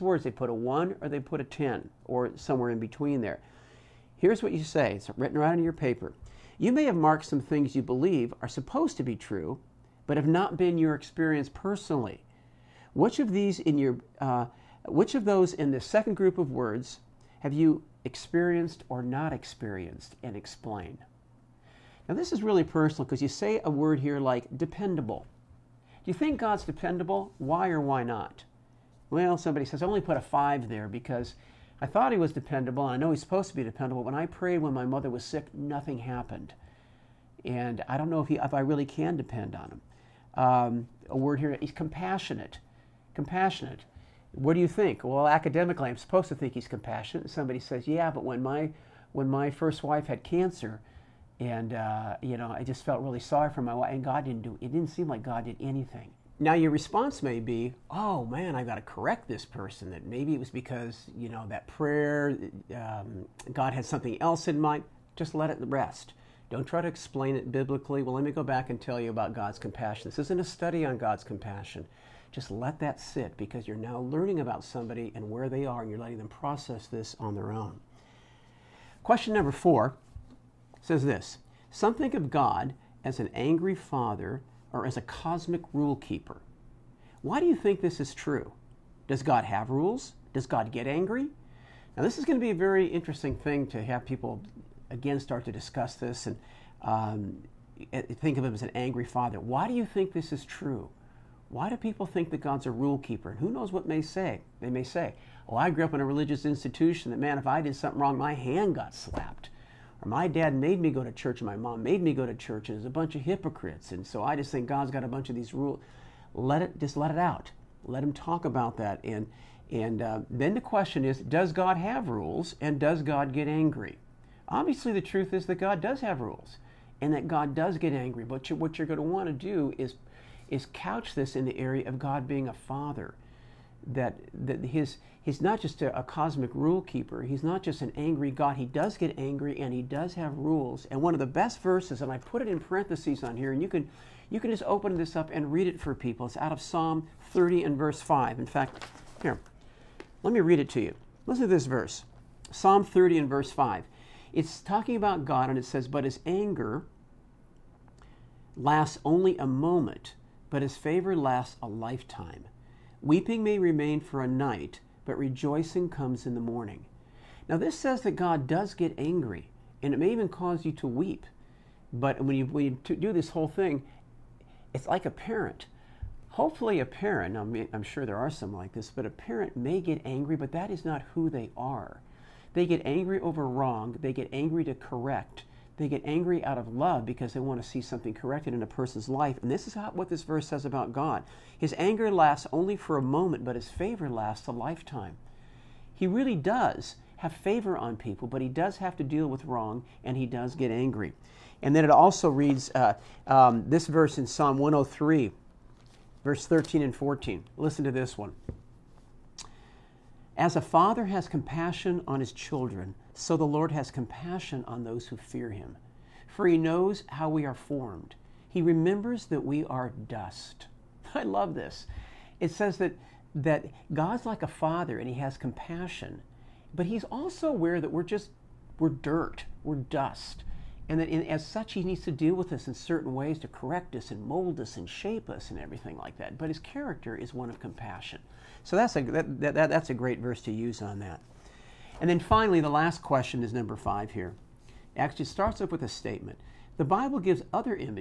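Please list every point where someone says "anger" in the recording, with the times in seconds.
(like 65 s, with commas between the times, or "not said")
156 s, 191 s.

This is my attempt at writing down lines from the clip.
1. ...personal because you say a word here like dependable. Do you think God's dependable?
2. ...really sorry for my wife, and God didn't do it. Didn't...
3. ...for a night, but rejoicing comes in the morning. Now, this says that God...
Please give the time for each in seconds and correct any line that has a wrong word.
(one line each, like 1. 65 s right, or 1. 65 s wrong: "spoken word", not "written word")
1. 22 s right
2. 53 s right
3. 163 s right.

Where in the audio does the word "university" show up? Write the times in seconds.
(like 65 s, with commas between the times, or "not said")
not said.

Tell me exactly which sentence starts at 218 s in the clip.
He remembers that we are dust.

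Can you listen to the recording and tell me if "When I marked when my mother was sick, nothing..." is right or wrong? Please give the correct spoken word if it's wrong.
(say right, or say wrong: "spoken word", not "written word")
wrong: "prayed", not "marked".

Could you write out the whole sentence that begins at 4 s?
Here's what you say it's written right on your paper.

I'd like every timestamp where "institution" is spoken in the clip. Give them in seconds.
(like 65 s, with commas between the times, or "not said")
106 s.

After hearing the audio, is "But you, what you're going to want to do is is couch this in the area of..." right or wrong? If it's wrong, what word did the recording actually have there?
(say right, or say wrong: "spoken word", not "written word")
right.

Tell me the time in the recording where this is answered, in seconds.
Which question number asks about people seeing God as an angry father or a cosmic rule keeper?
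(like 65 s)
79 s.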